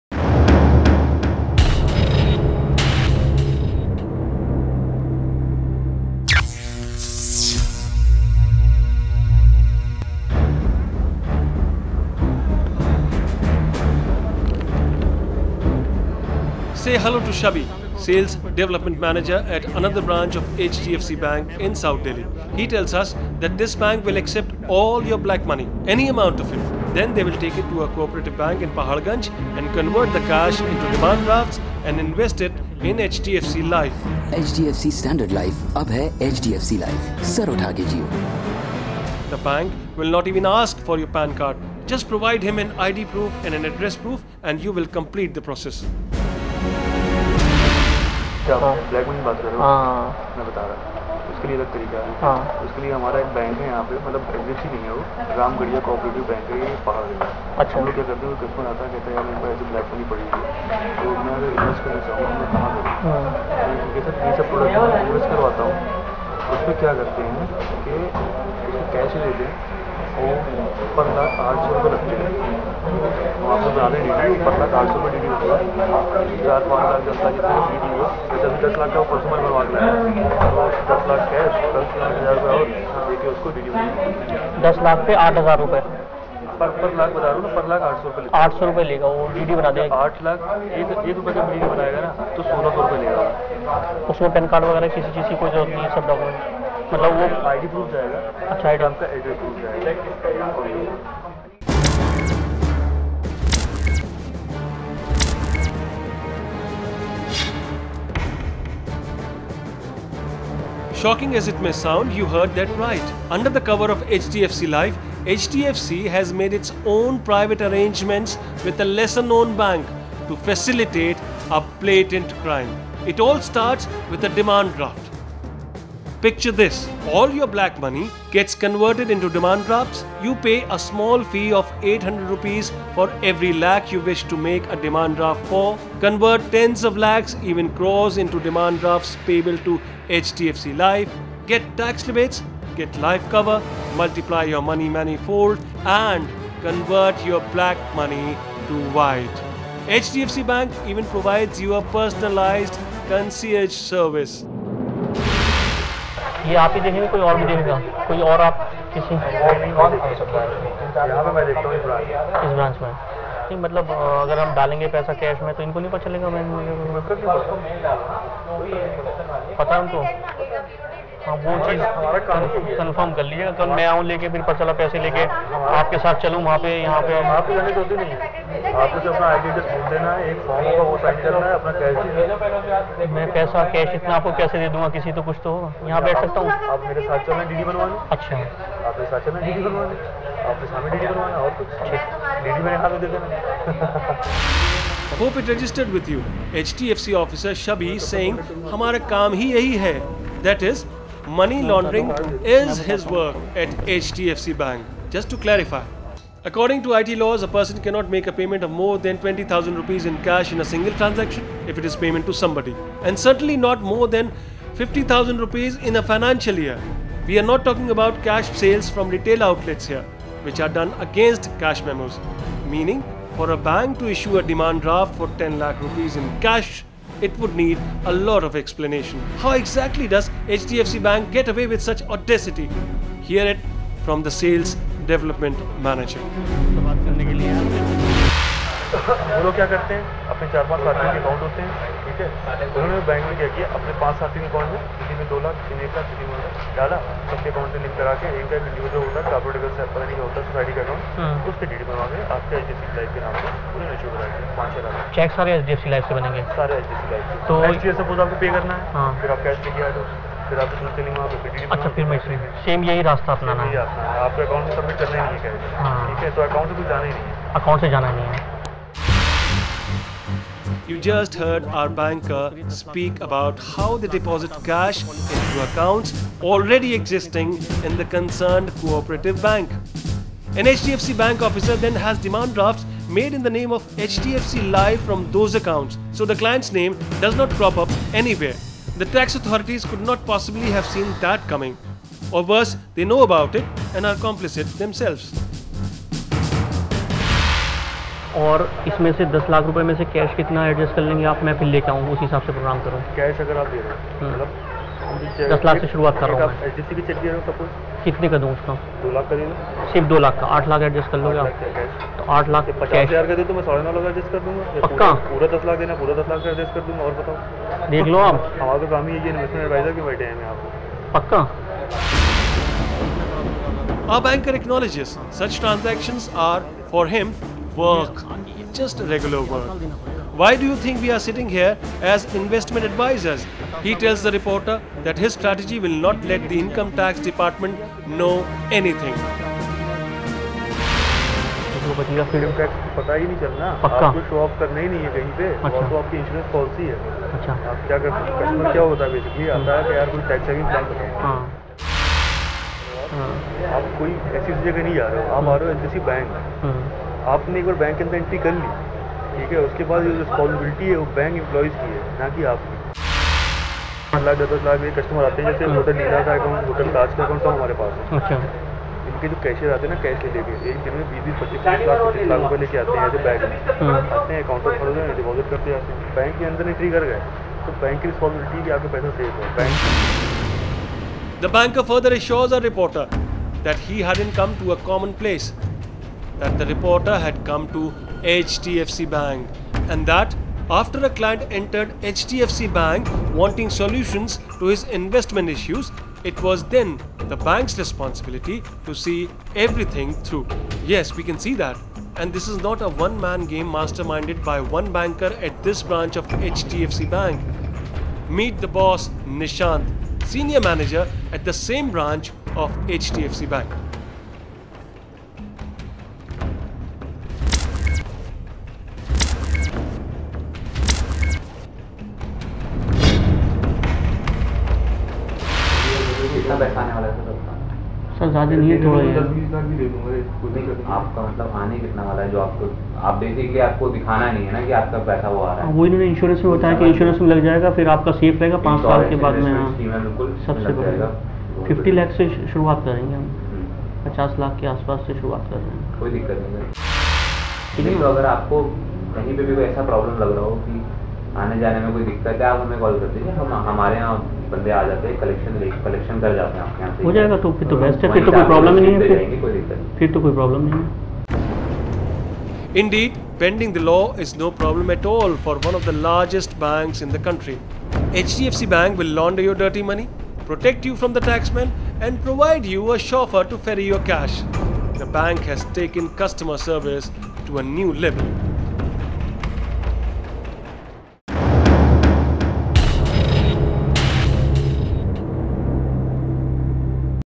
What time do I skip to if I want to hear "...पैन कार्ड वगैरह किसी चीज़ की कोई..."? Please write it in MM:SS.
01:34.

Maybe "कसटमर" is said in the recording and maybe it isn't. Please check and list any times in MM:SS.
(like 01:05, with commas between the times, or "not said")
00:58, 06:04.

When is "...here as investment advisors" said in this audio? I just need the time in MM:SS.
05:31.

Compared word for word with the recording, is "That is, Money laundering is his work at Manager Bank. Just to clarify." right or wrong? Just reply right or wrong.
wrong.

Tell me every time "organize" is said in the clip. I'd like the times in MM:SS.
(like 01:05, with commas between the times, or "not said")
not said.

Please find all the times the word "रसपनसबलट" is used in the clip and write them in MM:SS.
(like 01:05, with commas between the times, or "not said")
06:00, 06:18.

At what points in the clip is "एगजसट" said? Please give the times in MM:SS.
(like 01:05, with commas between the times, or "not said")
00:54.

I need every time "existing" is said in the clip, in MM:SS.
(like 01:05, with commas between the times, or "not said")
04:36.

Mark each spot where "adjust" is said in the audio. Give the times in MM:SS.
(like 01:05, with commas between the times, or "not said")
not said.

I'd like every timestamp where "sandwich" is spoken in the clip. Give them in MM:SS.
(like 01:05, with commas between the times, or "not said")
not said.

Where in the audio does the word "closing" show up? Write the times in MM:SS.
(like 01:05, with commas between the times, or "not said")
not said.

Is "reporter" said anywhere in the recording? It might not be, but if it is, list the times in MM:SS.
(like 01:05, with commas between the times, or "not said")
05:34, 06:22, 06:26.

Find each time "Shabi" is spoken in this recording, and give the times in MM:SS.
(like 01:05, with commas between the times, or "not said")
00:17, 03:17.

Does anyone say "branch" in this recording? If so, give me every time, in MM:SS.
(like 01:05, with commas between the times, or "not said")
00:20, 06:45, 06:51.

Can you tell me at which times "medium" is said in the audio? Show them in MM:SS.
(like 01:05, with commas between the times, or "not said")
not said.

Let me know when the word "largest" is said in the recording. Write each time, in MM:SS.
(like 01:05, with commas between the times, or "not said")
07:46.